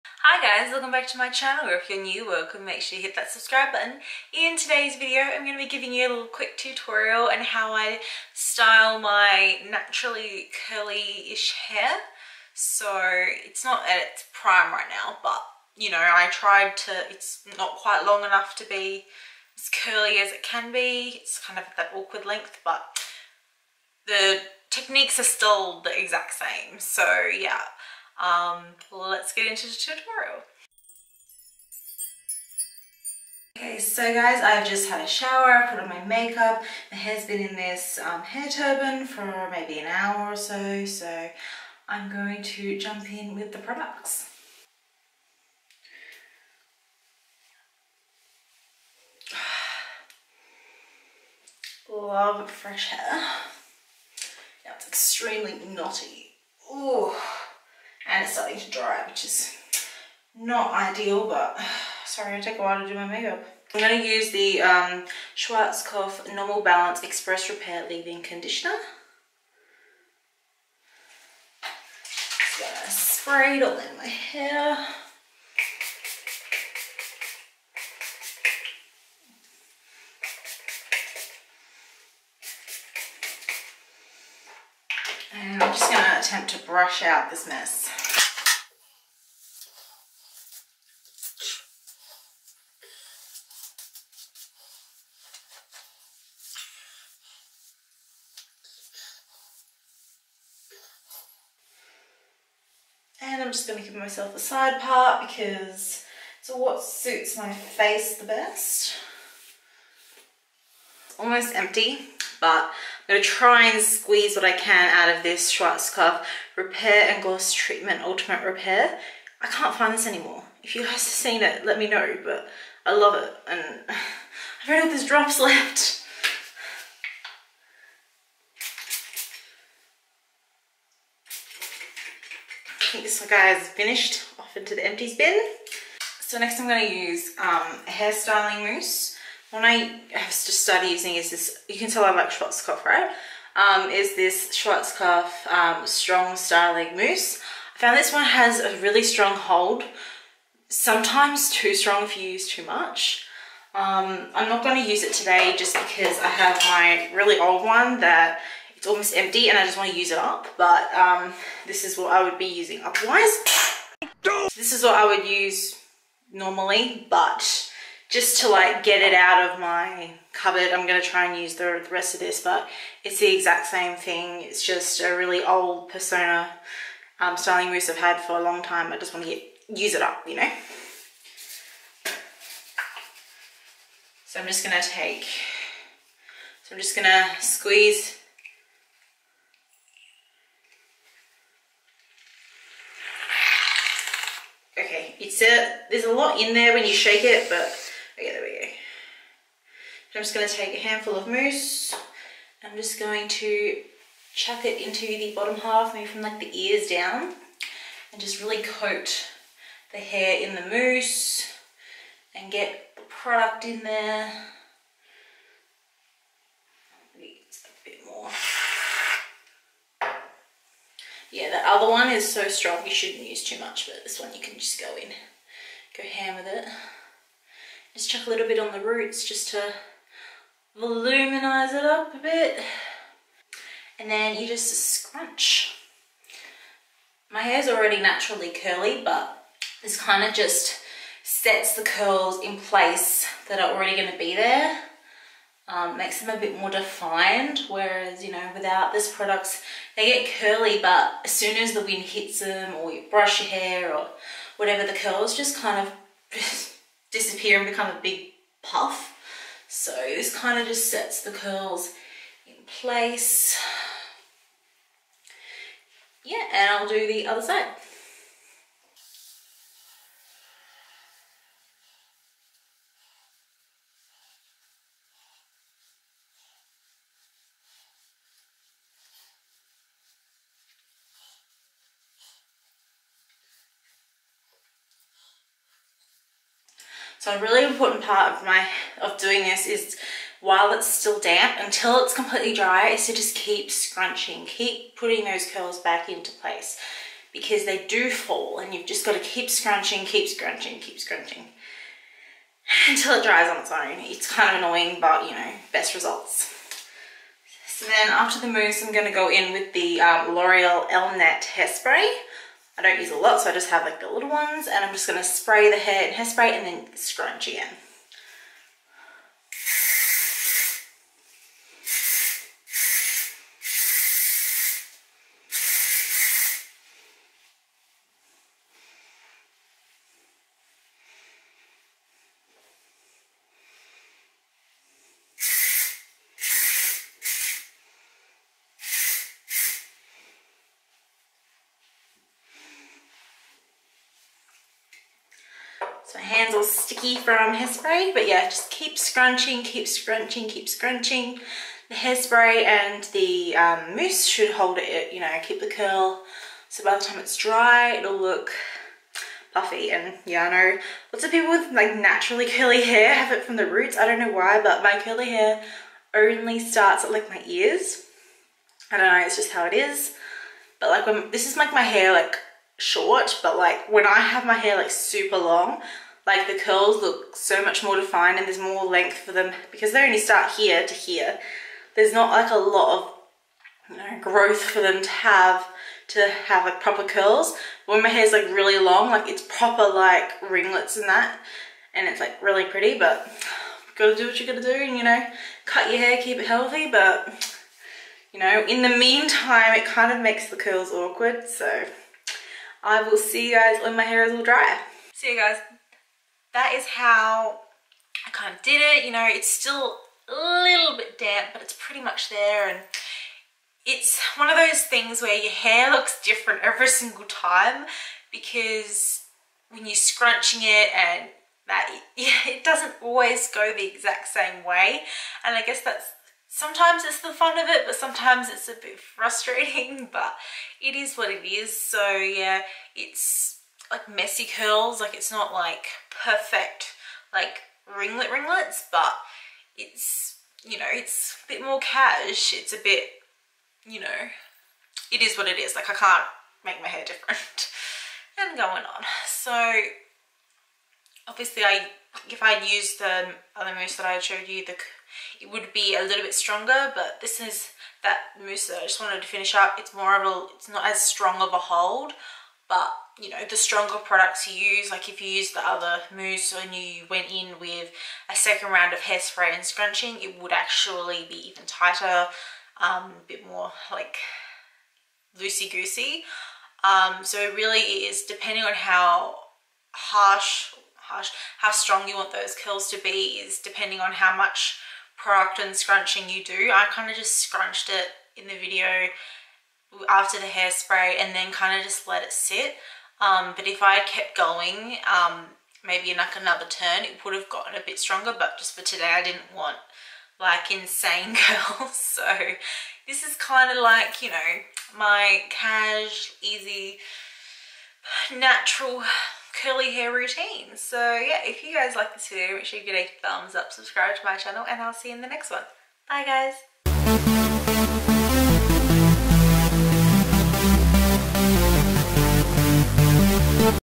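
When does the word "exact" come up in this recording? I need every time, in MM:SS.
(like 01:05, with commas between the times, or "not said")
00:26, 02:53, 07:03.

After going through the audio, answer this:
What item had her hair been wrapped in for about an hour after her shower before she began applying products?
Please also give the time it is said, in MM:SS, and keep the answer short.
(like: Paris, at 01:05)
hair turban, at 00:38.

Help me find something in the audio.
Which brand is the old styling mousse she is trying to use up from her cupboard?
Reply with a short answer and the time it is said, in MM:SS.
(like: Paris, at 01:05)
Persona, at 02:55.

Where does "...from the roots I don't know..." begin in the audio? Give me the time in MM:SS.
06:03.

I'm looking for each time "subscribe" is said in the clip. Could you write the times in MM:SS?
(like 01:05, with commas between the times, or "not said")
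00:03, 08:33.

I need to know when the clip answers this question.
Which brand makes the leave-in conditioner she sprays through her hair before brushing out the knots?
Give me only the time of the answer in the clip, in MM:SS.
01:05.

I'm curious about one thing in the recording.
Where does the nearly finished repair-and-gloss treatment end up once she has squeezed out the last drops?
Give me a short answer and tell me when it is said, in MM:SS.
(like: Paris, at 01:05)
empties bin, at 02:14.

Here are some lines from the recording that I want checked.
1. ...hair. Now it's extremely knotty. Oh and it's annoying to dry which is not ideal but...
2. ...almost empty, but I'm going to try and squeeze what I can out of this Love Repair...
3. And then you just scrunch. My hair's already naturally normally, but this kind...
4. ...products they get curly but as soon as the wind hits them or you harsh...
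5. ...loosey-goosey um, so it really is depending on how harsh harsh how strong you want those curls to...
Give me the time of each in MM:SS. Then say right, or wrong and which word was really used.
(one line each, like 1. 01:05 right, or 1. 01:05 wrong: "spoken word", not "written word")
1. 00:52 wrong: "starting", not "annoying"
2. 01:51 wrong: "Schwarzkopf", not "Love"
3. 03:53 wrong: "curly", not "normally"
4. 04:09 wrong: "brush", not "harsh"
5. 07:55 right.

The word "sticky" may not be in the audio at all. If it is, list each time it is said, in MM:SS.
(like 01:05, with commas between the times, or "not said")
05:46.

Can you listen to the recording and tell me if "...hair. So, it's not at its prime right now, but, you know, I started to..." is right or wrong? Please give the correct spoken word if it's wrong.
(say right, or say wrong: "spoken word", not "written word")
wrong: "tried", not "started".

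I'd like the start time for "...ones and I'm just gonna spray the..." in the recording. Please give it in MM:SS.
05:14.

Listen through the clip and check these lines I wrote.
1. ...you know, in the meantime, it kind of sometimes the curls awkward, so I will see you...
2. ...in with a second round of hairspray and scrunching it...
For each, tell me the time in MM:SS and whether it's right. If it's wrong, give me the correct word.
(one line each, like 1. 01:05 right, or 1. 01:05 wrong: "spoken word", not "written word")
1. 06:38 wrong: "makes", not "sometimes"
2. 07:47 right.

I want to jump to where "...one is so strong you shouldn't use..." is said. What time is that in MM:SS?
03:41.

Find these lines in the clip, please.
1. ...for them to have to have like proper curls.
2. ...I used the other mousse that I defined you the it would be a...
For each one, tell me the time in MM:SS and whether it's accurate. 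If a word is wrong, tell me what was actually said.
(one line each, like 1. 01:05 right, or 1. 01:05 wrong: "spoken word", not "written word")
1. 06:24 right
2. 07:32 wrong: "showed", not "defined".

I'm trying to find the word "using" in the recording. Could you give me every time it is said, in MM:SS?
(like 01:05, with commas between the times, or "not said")
02:20, 02:42.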